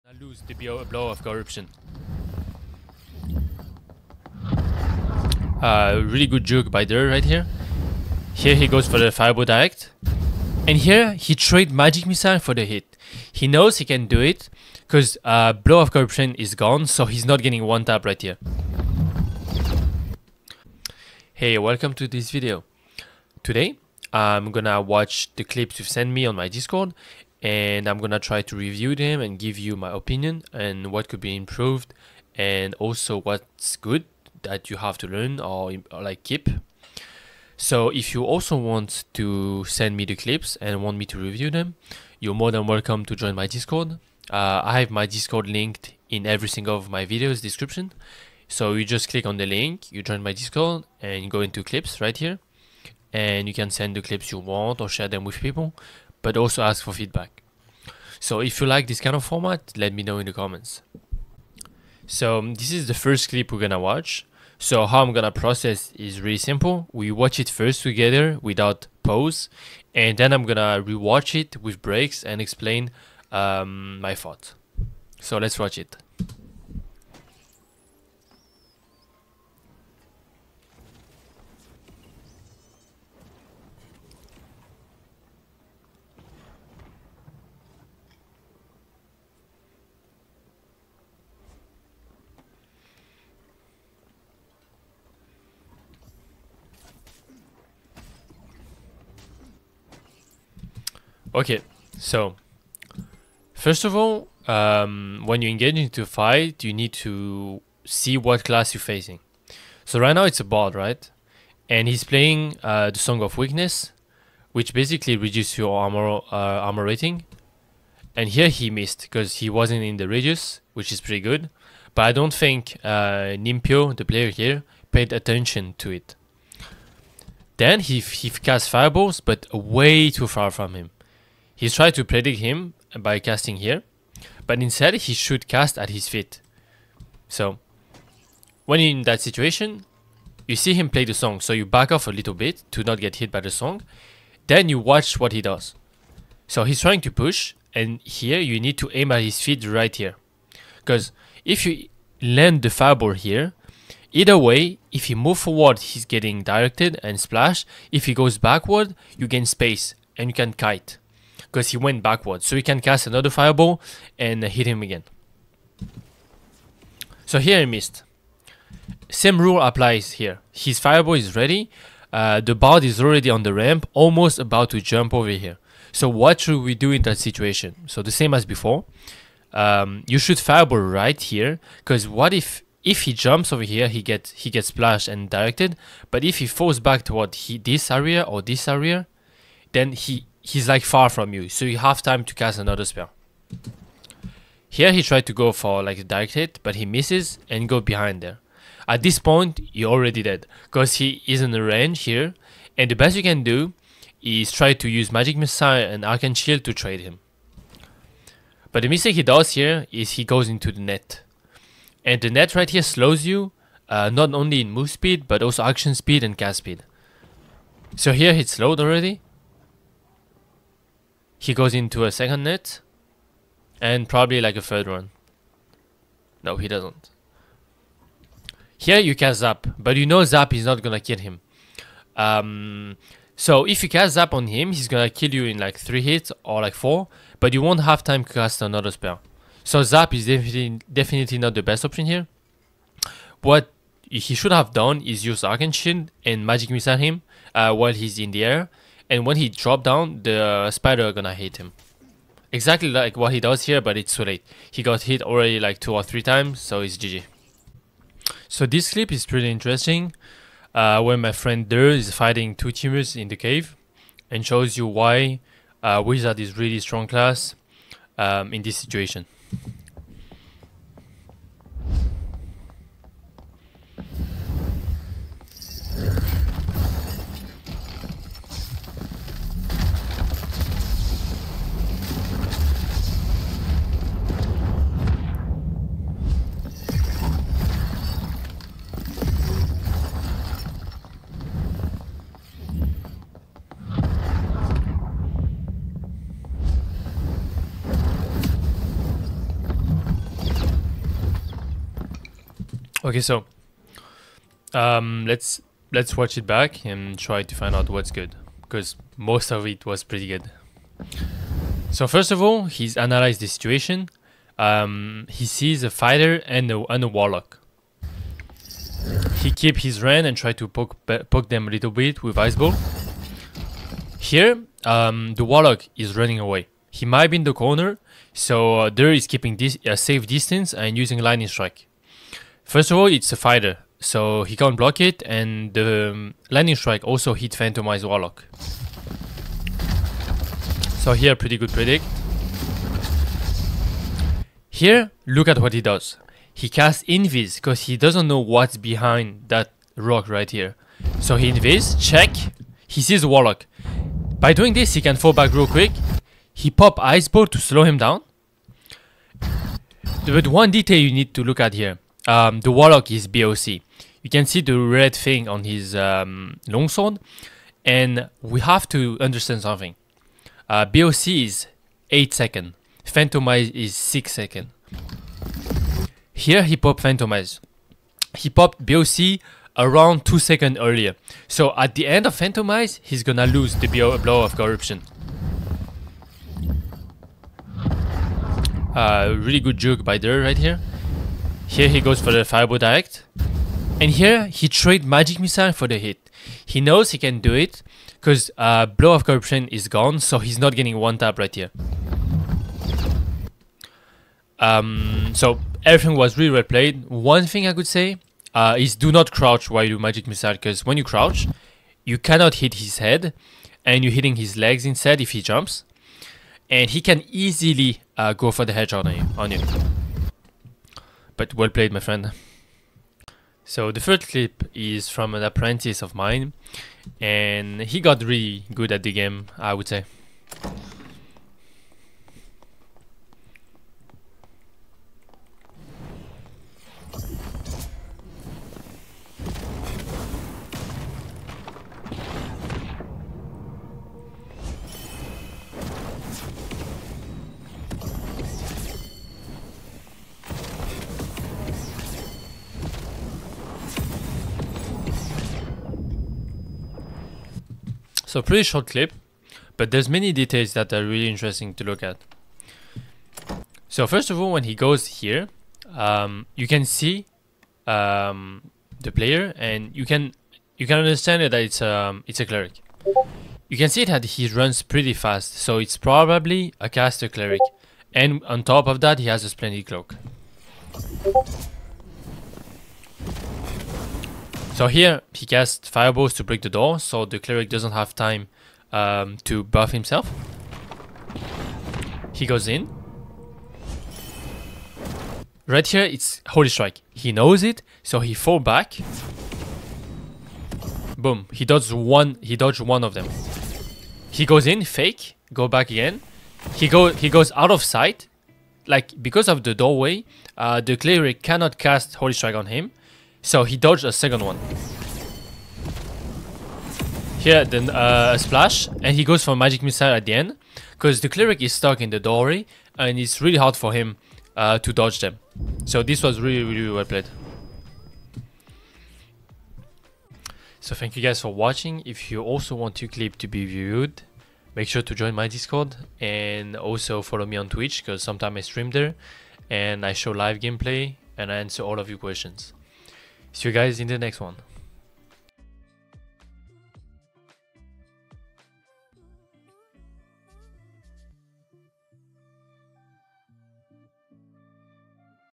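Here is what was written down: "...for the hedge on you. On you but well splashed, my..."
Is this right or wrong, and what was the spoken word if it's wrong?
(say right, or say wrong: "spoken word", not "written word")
wrong: "played", not "splashed".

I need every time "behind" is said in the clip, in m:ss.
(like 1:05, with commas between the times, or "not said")
3:17, 5:48.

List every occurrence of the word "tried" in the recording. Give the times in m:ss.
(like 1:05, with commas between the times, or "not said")
2:11, 3:15.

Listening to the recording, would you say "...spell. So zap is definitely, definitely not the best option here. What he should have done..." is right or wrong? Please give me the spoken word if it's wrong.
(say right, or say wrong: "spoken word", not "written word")
right.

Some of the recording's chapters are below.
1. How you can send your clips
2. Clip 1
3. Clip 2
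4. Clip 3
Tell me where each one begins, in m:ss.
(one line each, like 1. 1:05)
1. 0:20
2. 1:15
3. 4:18
4. 7:00.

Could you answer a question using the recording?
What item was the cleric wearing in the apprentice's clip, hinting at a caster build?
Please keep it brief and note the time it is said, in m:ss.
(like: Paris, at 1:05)
splendid cloak, at 7:59.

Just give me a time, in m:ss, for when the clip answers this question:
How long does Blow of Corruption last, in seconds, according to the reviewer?
6:12.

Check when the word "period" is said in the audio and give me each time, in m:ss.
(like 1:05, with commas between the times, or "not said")
not said.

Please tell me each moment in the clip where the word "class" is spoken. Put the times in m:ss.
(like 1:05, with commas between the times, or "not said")
1:48, 4:27.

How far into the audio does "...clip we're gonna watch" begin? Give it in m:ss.
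1:03.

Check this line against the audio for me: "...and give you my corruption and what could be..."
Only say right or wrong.
wrong.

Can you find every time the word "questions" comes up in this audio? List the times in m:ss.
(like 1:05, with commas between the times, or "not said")
9:02.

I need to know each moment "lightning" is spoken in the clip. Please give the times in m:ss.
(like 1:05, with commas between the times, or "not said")
5:31, 5:36.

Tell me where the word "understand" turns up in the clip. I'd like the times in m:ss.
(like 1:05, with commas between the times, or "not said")
6:09, 7:50.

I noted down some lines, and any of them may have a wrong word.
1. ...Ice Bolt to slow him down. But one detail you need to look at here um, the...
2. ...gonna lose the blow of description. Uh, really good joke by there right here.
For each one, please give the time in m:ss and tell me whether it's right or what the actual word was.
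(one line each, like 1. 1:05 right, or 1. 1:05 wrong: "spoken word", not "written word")
1. 5:57 right
2. 6:23 wrong: "corruption", not "description".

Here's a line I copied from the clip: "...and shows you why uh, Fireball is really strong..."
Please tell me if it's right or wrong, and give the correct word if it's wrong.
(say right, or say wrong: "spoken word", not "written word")
wrong: "Wizard", not "Fireball".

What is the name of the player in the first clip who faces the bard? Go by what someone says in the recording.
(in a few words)
Nimpio.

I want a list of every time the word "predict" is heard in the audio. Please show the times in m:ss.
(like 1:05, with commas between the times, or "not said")
2:12, 5:41.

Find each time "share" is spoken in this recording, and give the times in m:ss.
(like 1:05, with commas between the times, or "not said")
0:54.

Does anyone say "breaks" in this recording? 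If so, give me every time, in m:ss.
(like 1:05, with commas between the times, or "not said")
1:11, 8:06.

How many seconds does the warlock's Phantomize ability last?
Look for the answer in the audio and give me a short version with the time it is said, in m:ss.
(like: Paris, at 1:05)
6, at 6:13.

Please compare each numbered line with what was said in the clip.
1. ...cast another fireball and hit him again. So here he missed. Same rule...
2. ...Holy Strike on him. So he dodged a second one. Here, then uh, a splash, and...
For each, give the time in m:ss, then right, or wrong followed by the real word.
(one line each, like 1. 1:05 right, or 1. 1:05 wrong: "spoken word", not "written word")
1. 2:42 right
2. 8:32 right.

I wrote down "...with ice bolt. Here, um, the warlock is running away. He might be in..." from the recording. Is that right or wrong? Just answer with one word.
right.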